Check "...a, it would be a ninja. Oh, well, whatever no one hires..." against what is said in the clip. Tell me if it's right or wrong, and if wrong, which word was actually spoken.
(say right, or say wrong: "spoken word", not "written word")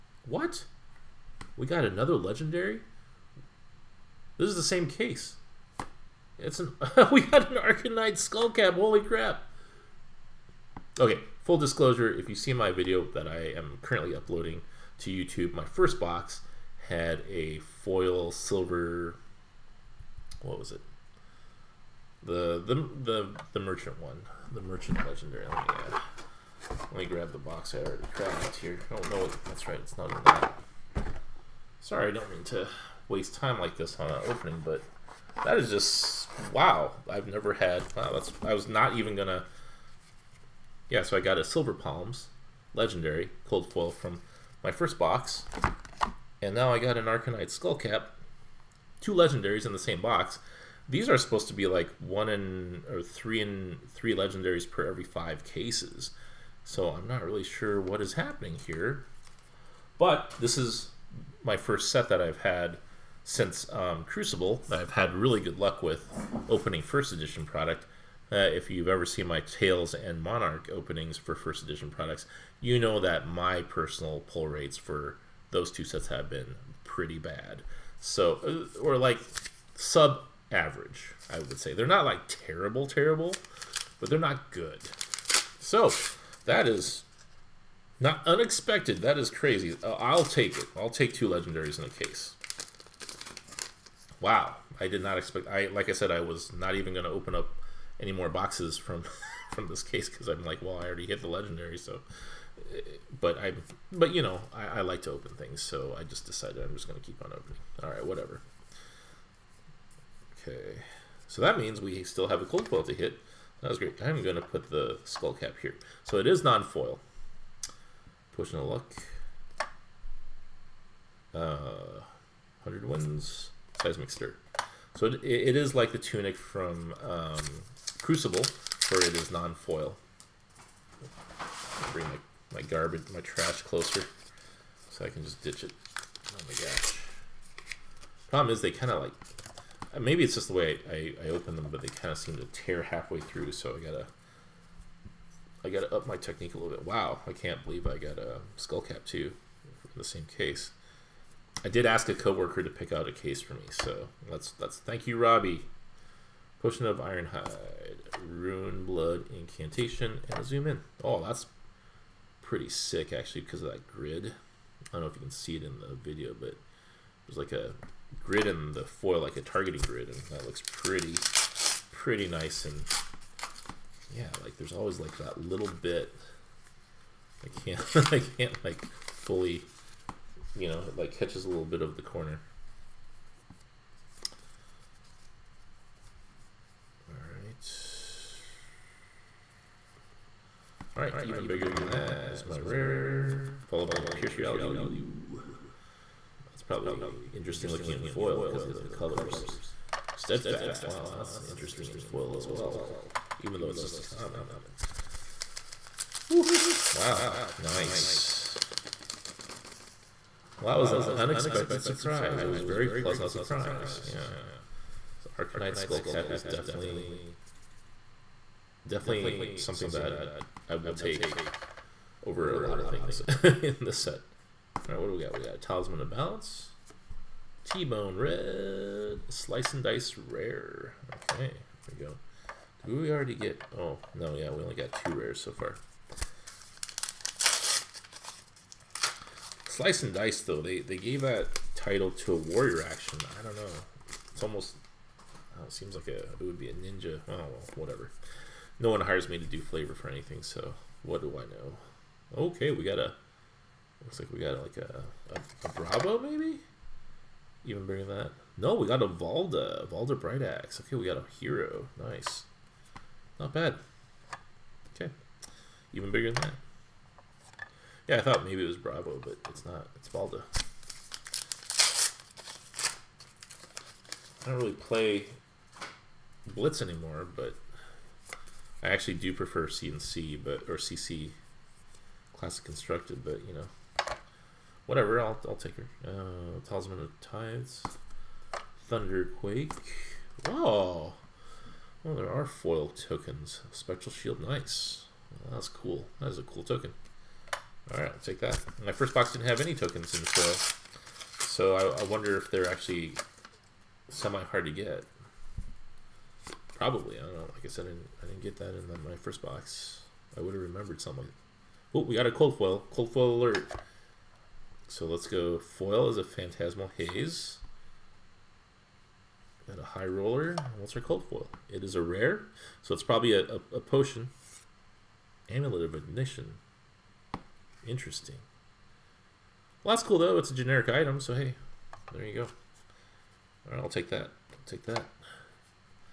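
right.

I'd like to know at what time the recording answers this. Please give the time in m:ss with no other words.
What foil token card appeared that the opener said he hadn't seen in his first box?
4:53.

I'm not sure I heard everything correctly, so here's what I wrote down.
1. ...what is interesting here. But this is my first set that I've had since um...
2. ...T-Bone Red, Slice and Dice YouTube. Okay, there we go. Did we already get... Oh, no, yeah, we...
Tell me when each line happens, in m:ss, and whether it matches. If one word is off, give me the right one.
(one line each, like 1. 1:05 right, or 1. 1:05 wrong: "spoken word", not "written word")
1. 0:57 wrong: "happening", not "interesting"
2. 3:47 wrong: "Rare", not "YouTube".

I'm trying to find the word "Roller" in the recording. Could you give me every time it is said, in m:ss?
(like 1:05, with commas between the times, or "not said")
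5:20.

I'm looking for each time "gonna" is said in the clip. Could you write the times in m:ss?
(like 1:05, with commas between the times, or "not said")
0:39, 1:46, 1:54.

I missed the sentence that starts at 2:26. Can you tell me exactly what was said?
Wow, I can't believe I got a skull cap too, in the same case.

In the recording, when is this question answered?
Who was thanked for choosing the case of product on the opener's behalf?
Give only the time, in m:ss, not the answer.
2:35.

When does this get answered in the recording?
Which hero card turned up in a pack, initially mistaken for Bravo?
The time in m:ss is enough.
4:19.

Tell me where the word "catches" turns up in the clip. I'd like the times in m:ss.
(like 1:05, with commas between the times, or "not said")
3:01.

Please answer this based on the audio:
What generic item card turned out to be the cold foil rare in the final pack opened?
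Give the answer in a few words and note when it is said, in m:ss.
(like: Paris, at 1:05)
Amulet of Ignition, at 5:25.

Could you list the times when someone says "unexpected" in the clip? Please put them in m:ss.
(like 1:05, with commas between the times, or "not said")
1:28, 3:31.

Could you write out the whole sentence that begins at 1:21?
They're not like terrible, terrible, but they're not good.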